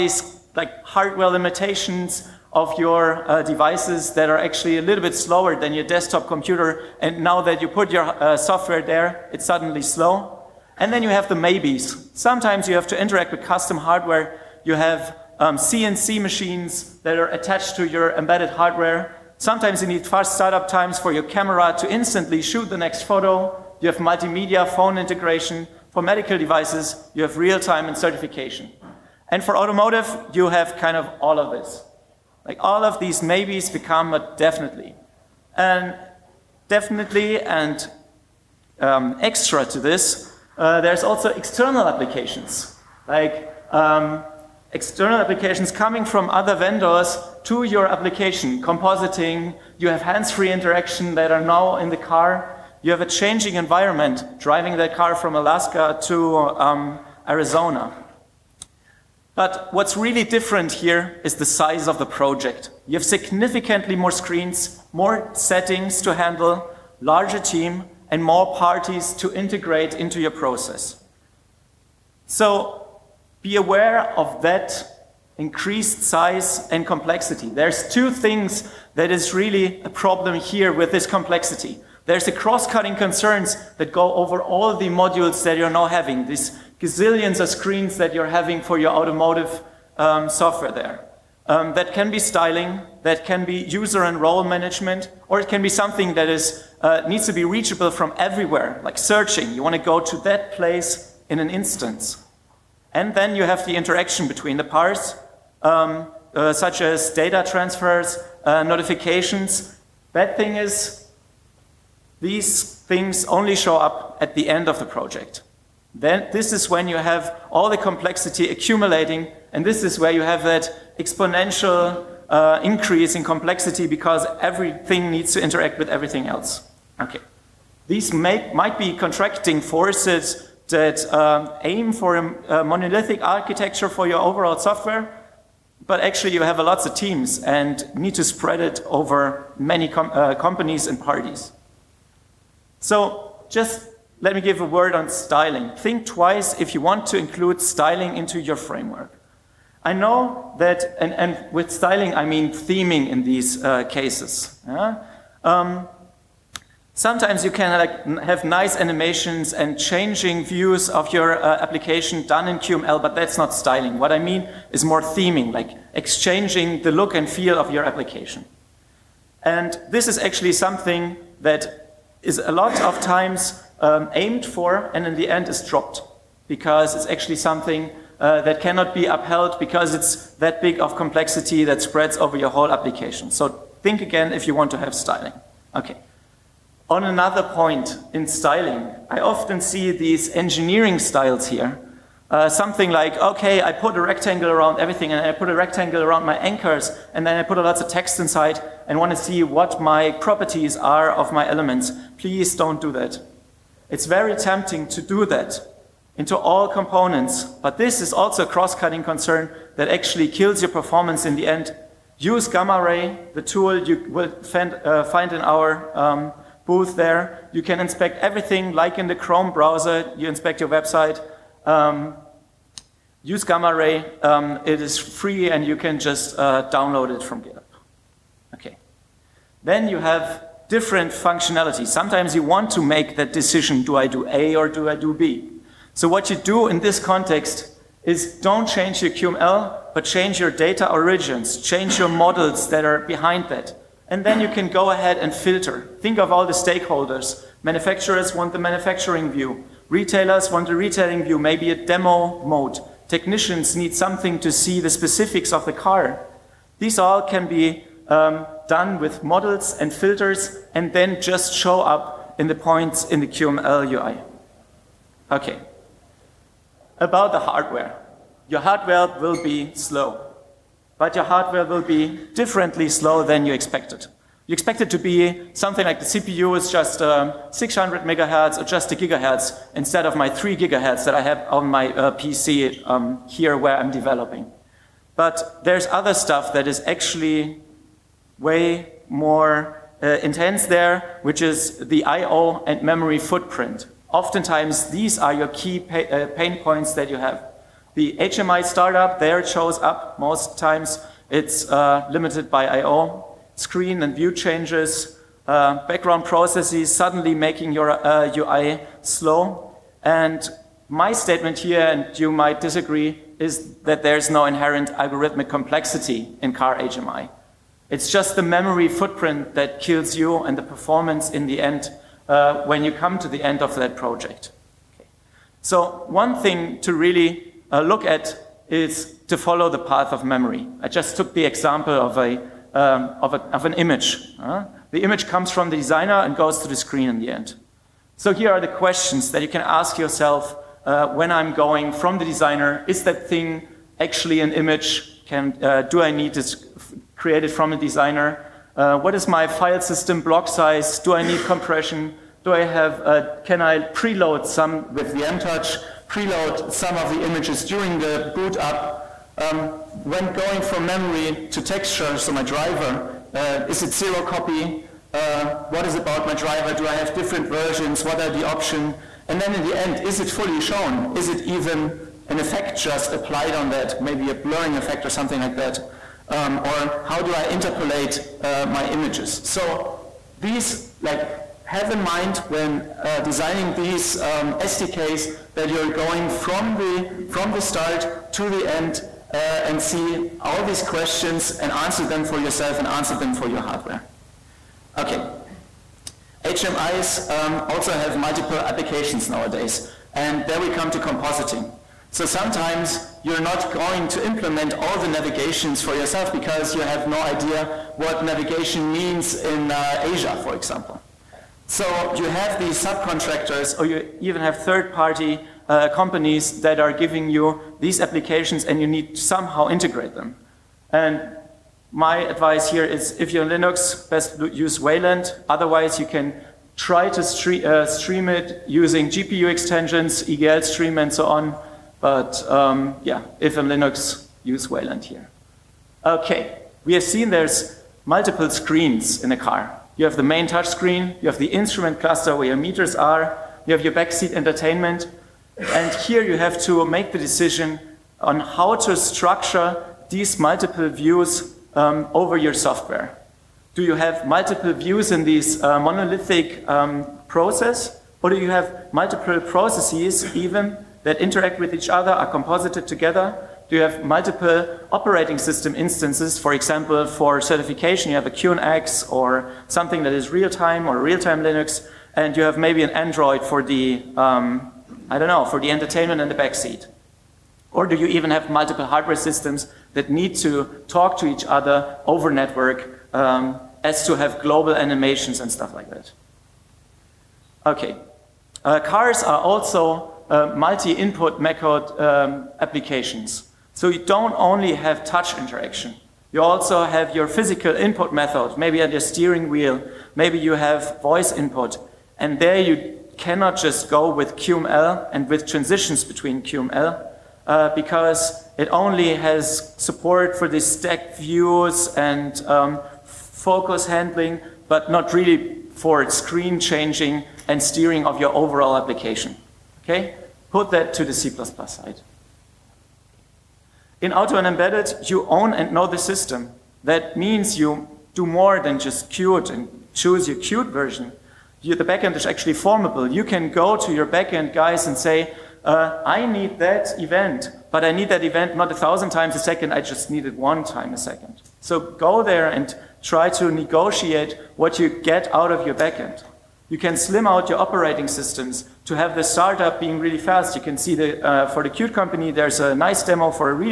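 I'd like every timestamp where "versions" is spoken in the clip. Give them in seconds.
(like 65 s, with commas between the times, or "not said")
367 s, 530 s.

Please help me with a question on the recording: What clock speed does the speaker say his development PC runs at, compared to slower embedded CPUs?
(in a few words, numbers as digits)
3 gigahertz.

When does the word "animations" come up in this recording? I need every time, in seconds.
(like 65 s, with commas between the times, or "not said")
158 s, 484 s.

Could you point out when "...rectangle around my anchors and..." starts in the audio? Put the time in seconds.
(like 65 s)
195 s.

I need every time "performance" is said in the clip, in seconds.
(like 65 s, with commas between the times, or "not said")
210 s, 320 s.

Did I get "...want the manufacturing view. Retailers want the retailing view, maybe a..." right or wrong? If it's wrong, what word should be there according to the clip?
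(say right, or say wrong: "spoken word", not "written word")
right.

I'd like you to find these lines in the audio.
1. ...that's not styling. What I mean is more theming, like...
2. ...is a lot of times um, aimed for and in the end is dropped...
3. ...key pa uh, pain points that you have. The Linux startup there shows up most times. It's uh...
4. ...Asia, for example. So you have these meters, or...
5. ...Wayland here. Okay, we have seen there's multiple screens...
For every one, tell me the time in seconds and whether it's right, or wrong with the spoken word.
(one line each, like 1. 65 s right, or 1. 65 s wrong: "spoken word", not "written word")
1. 163 s right
2. 172 s right
3. 295 s wrong: "HMI", not "Linux"
4. 410 s wrong: "subcontractors", not "meters"
5. 434 s right.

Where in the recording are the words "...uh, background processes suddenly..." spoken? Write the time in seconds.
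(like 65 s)
305 s.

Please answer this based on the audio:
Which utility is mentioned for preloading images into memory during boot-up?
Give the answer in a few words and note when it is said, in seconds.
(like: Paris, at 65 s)
VMTouch, at 355 s.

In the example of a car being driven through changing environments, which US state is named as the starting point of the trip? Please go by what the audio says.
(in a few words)
Alaska.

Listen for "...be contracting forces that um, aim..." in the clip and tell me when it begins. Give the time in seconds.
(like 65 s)
128 s.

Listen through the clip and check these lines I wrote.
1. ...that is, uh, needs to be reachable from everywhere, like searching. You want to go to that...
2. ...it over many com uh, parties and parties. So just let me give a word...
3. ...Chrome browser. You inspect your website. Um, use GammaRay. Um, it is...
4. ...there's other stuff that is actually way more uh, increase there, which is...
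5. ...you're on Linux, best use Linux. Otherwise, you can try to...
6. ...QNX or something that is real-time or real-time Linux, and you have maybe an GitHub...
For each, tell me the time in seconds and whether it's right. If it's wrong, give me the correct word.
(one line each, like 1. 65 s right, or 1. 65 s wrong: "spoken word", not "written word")
1. 96 s right
2. 138 s wrong: "companies", not "parties"
3. 219 s right
4. 285 s wrong: "intense", not "increase"
5. 423 s wrong: "Wayland", not "Linux"
6. 468 s wrong: "Android", not "GitHub".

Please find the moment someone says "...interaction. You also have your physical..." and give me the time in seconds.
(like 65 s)
495 s.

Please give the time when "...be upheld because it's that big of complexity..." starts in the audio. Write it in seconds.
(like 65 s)
178 s.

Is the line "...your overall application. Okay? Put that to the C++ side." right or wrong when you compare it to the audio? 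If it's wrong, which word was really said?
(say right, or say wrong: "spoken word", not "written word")
right.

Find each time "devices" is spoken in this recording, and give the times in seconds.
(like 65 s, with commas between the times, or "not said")
3 s, 26 s.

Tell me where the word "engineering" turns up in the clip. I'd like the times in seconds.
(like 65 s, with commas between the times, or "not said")
190 s.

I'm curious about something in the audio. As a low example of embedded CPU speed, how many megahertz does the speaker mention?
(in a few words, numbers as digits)
600.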